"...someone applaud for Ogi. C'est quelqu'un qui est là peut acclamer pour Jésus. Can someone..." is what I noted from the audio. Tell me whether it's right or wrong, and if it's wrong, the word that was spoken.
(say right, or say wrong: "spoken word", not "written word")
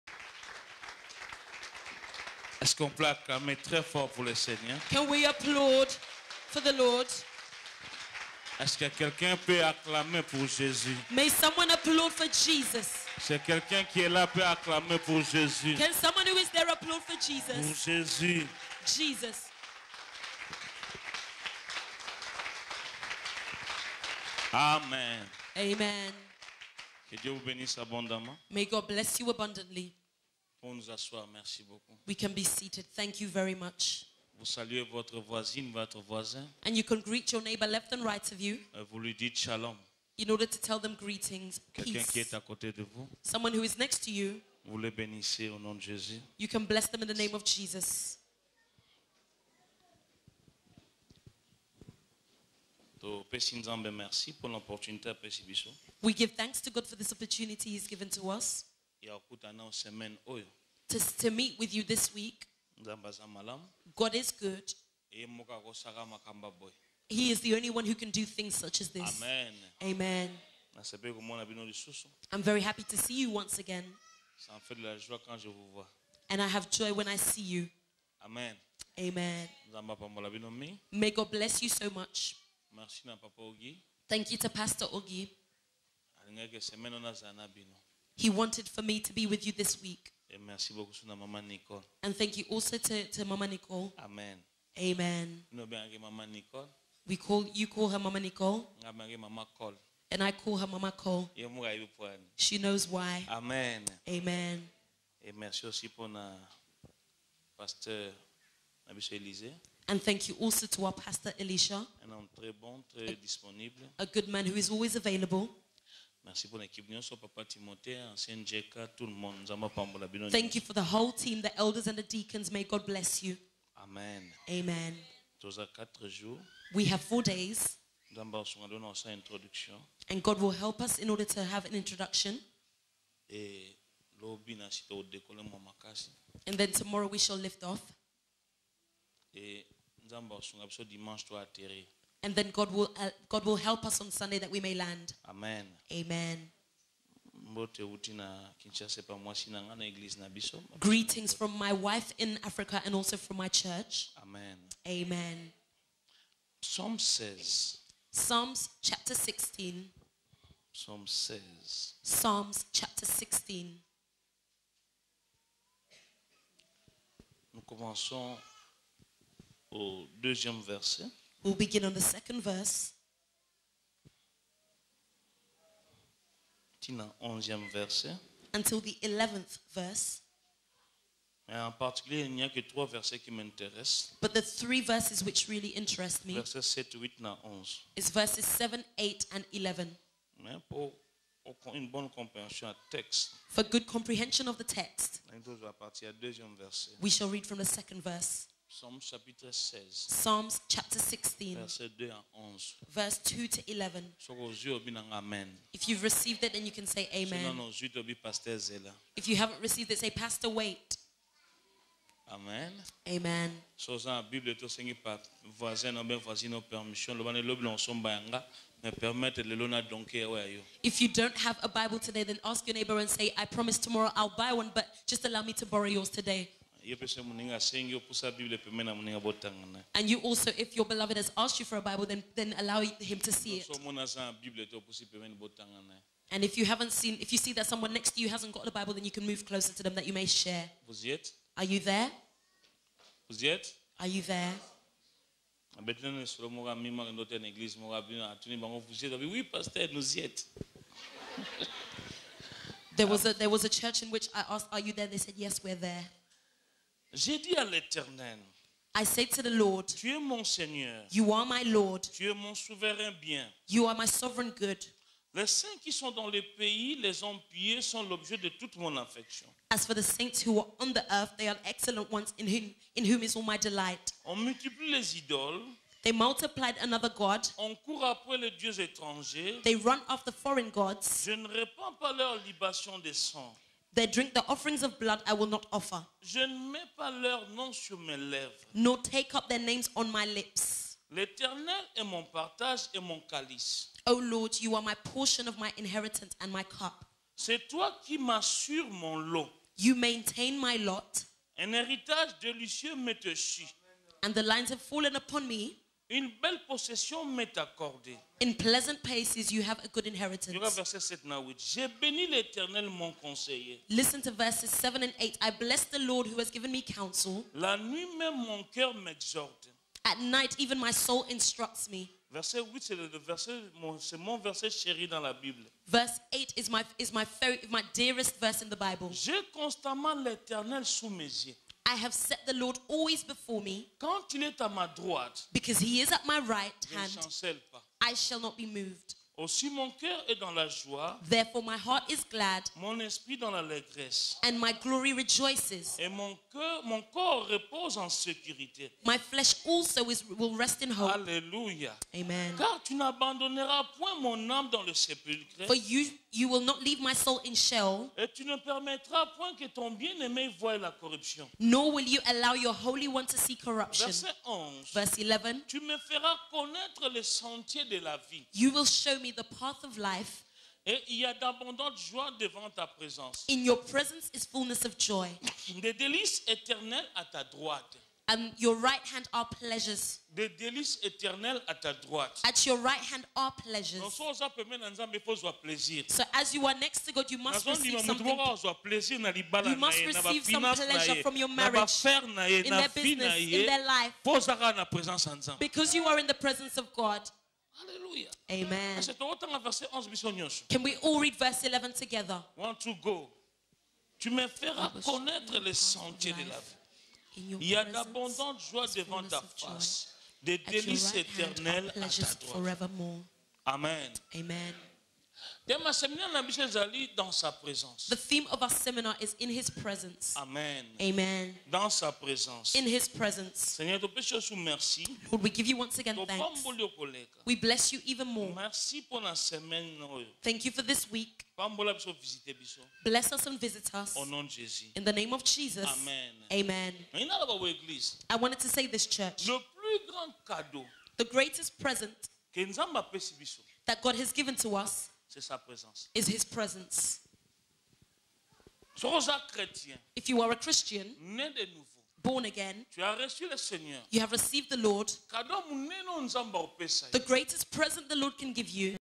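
wrong: "Jesus", not "Ogi".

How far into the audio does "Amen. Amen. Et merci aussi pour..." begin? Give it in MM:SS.
01:43.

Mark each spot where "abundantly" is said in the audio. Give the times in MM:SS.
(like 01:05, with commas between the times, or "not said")
00:29.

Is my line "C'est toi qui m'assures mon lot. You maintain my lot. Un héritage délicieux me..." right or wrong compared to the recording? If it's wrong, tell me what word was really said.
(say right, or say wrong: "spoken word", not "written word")
right.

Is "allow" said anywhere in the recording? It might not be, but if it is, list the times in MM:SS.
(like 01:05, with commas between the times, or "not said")
03:45, 03:52, 06:02.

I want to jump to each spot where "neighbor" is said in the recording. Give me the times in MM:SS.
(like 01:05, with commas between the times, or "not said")
00:37, 03:42.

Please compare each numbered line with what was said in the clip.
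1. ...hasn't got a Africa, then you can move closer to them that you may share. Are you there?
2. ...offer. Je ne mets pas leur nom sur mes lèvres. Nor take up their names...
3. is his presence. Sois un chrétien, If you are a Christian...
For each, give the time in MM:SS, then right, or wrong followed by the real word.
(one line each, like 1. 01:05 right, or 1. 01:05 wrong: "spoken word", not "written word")
1. 03:58 wrong: "Bible", not "Africa"
2. 04:45 right
3. 07:26 right.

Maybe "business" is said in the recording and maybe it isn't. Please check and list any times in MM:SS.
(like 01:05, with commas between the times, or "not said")
06:32.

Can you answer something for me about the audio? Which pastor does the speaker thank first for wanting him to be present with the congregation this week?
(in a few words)
Pastor Ogi.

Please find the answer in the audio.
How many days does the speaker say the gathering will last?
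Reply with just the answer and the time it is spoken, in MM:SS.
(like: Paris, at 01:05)
4, at 02:07.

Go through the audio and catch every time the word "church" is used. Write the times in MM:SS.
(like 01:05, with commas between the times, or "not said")
02:33, 04:13, 07:19.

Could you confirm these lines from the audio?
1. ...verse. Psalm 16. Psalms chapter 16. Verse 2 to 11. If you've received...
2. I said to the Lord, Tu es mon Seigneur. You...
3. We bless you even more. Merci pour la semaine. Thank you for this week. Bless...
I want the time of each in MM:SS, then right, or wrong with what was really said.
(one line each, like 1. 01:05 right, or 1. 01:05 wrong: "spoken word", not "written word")
1. 03:18 right
2. 04:18 right
3. 07:07 right.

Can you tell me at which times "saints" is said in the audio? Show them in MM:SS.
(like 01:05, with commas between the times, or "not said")
04:25, 04:30.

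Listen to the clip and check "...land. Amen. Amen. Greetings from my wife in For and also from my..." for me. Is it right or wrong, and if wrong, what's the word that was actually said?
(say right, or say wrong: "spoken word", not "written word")
wrong: "Africa", not "For".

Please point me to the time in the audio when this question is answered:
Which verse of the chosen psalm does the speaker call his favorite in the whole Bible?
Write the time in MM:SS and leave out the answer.
05:22.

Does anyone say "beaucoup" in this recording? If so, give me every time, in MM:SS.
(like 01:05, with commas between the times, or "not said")
00:31, 01:30.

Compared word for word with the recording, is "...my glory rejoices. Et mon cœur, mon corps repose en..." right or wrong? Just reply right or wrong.
right.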